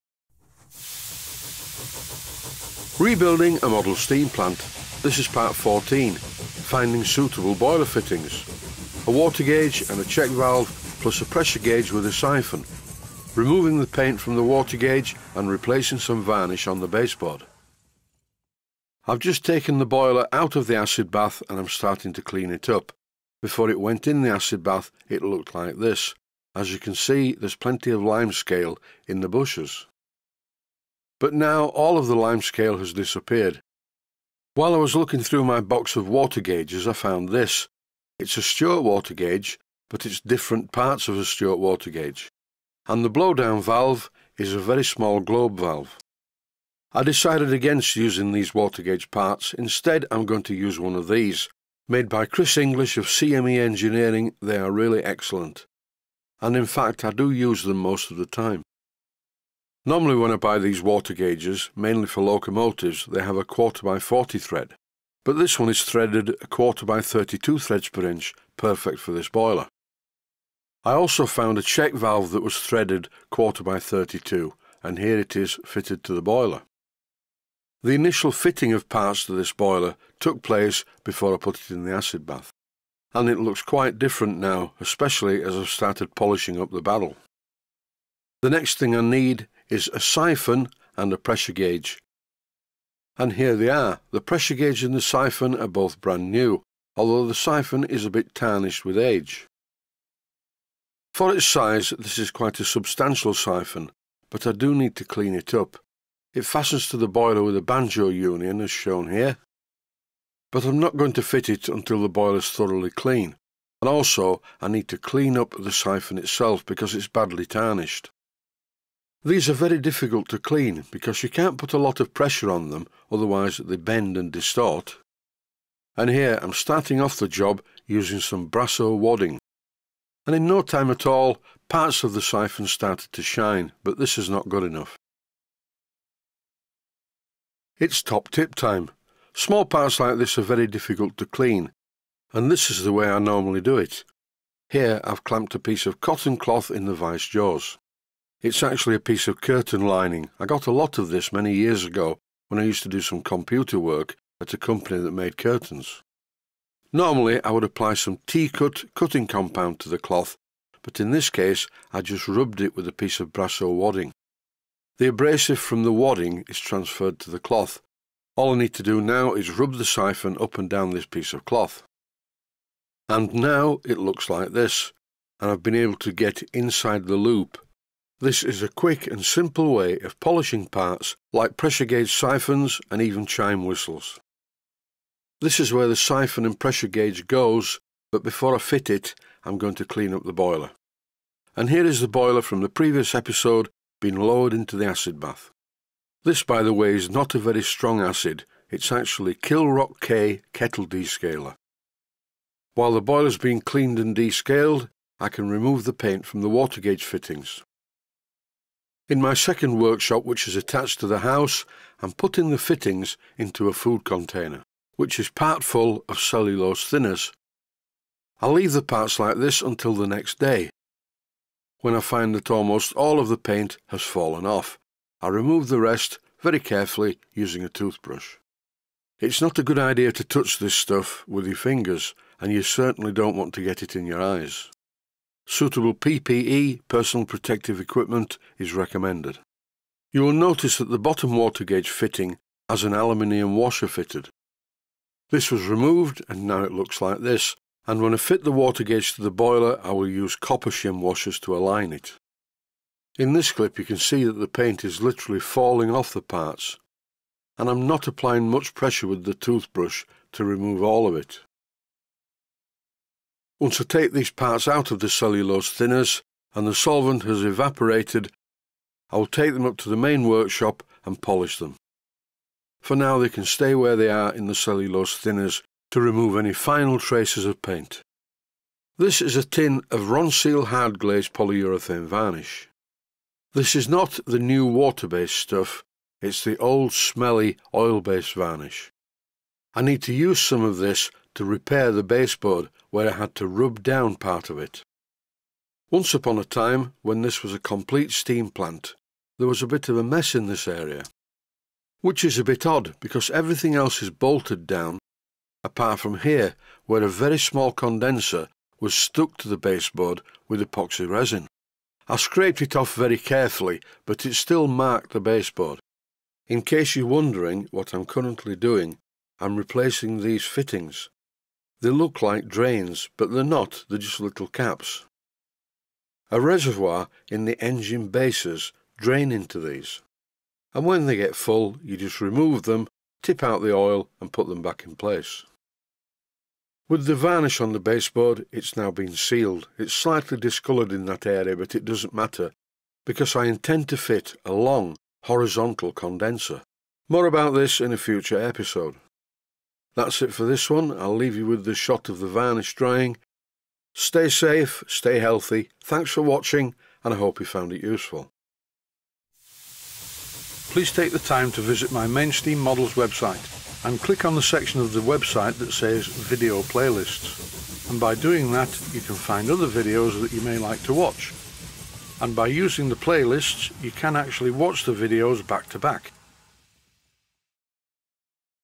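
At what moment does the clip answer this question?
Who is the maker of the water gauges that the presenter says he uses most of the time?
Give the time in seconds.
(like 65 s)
52 s.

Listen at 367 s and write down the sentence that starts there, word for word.
And by doing that, you can find other videos that you may like to watch.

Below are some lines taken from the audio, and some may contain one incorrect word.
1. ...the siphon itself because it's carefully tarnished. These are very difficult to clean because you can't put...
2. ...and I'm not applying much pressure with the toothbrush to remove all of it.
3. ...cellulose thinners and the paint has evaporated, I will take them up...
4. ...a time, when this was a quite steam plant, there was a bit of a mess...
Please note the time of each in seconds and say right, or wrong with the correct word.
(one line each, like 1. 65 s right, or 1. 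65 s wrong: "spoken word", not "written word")
1. 115 s wrong: "badly", not "carefully"
2. 257 s right
3. 265 s wrong: "solvent", not "paint"
4. 296 s wrong: "complete", not "quite".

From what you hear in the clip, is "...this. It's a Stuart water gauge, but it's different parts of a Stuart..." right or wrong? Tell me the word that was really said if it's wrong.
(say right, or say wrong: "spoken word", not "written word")
right.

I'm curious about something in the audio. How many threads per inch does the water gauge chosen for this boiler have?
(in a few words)
32.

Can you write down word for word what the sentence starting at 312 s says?
I scraped it off very carefully, but it still marked the baseboard.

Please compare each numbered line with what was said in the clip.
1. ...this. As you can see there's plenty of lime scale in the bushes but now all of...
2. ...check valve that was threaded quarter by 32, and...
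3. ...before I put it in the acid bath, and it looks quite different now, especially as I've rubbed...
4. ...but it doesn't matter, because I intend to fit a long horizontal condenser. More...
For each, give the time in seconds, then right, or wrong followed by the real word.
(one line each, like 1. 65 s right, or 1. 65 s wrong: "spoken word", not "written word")
1. 25 s right
2. 71 s right
3. 81 s wrong: "started", not "rubbed"
4. 341 s right.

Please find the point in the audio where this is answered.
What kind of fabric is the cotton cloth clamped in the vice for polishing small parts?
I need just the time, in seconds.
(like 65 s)
149 s.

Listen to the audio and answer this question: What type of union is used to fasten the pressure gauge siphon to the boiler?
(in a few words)
banjo union.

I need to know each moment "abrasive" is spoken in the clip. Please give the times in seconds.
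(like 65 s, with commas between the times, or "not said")
165 s.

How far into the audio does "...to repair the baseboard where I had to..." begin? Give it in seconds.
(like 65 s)
291 s.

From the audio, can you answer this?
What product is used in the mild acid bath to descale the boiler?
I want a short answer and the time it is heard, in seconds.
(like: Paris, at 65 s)
Kilrock K kettle descaler, at 199 s.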